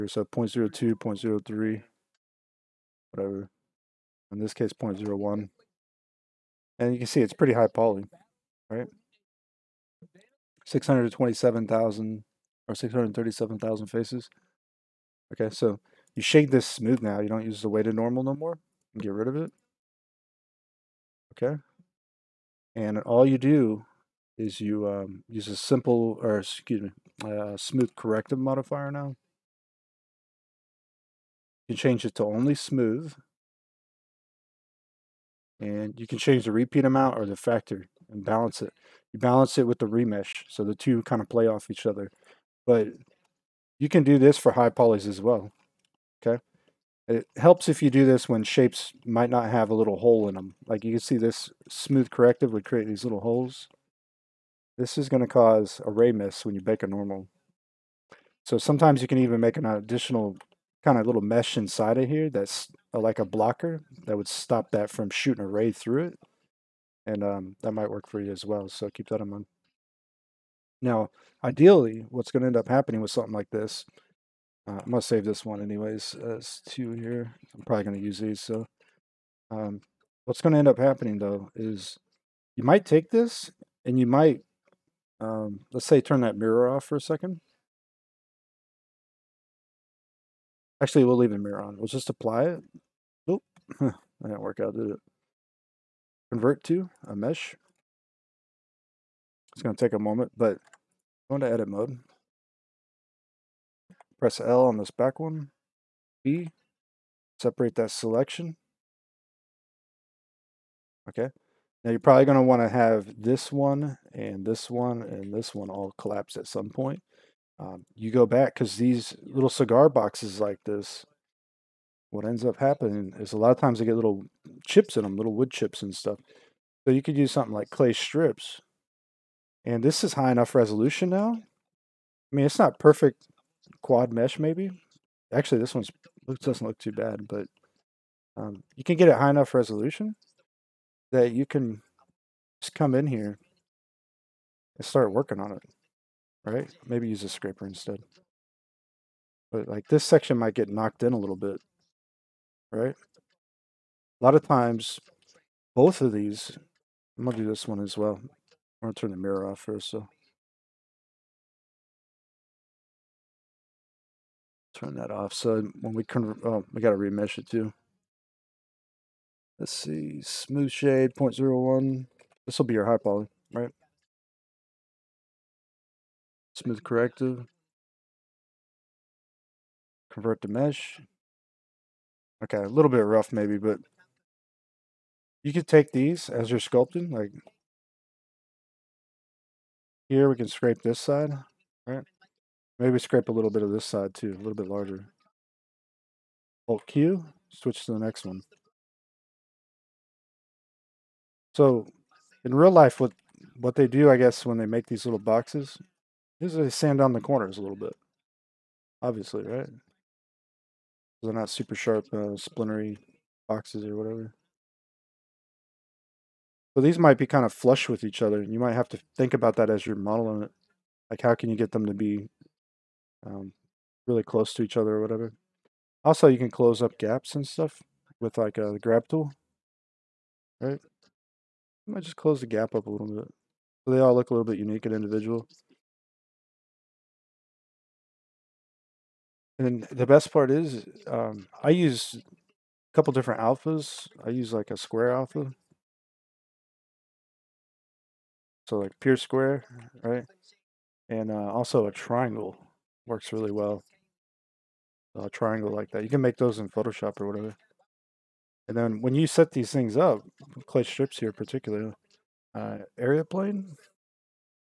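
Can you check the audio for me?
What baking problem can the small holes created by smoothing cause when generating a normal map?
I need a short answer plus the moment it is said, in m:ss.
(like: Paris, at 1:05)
a ray miss, at 0:55.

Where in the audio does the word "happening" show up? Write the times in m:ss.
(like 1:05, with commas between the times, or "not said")
1:12, 1:20, 2:02.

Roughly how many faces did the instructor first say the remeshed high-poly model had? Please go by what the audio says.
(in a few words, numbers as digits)
627,000.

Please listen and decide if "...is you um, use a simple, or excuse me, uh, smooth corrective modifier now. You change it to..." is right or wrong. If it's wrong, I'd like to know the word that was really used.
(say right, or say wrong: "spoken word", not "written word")
right.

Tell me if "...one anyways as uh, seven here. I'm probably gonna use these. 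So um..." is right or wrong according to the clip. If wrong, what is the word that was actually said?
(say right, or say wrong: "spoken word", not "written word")
wrong: "two", not "seven".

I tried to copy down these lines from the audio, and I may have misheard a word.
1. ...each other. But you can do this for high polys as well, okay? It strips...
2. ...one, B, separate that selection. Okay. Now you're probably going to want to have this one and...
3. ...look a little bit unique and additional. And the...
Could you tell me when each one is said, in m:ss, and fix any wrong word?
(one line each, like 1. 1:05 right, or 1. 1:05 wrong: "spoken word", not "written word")
1. 0:41 wrong: "helps", not "strips"
2. 1:45 right
3. 3:54 wrong: "individual", not "additional".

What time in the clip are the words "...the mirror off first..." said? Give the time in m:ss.
2:39.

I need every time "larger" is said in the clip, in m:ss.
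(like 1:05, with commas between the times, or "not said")
3:14.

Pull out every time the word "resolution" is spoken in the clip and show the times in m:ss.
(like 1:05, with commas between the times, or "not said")
2:10, 2:19.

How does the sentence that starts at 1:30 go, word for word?
Actually, we'll leave the mirror on.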